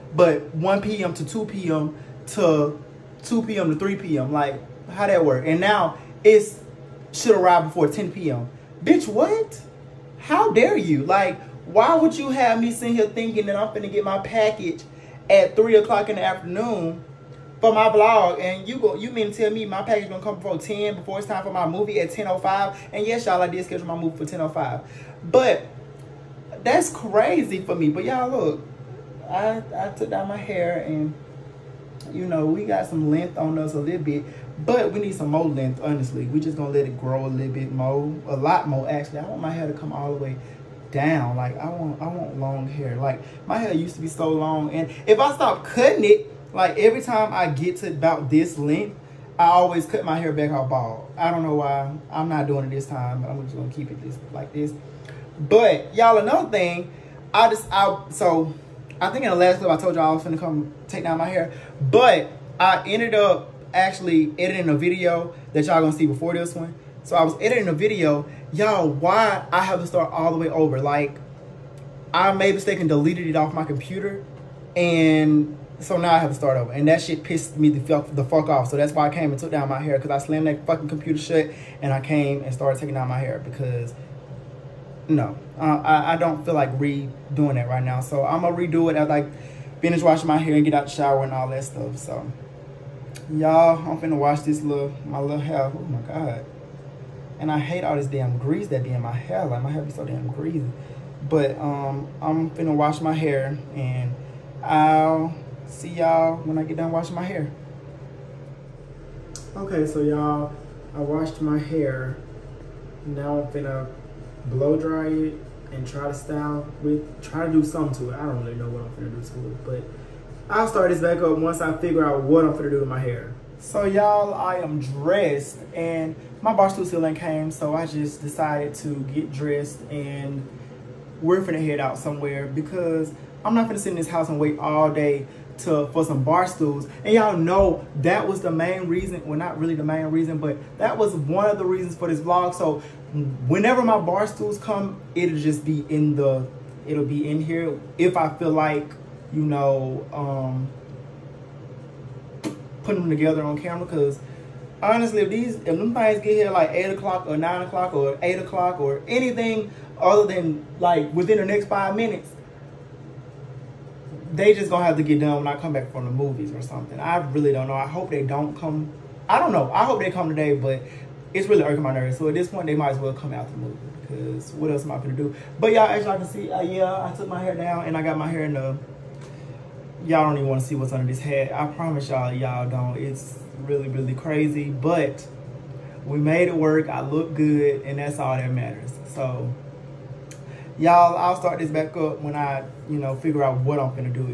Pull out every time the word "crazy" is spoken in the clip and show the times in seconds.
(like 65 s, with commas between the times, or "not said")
26 s, 184 s.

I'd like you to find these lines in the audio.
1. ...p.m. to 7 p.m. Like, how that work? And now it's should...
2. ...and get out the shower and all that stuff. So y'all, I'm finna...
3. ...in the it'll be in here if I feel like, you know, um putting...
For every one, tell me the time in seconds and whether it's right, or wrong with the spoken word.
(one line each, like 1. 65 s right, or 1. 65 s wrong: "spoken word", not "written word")
1. 3 s wrong: "3", not "7"
2. 90 s right
3. 145 s right.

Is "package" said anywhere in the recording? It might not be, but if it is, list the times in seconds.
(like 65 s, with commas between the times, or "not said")
14 s, 19 s.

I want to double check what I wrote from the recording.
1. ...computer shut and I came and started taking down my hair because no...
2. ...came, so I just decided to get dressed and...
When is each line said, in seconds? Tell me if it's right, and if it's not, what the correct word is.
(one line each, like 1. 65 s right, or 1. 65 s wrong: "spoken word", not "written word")
1. 80 s right
2. 127 s right.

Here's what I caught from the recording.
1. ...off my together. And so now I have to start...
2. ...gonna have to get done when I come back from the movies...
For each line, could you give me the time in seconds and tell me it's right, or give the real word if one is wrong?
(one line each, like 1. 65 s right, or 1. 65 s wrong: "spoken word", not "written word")
1. 73 s wrong: "computer", not "together"
2. 164 s right.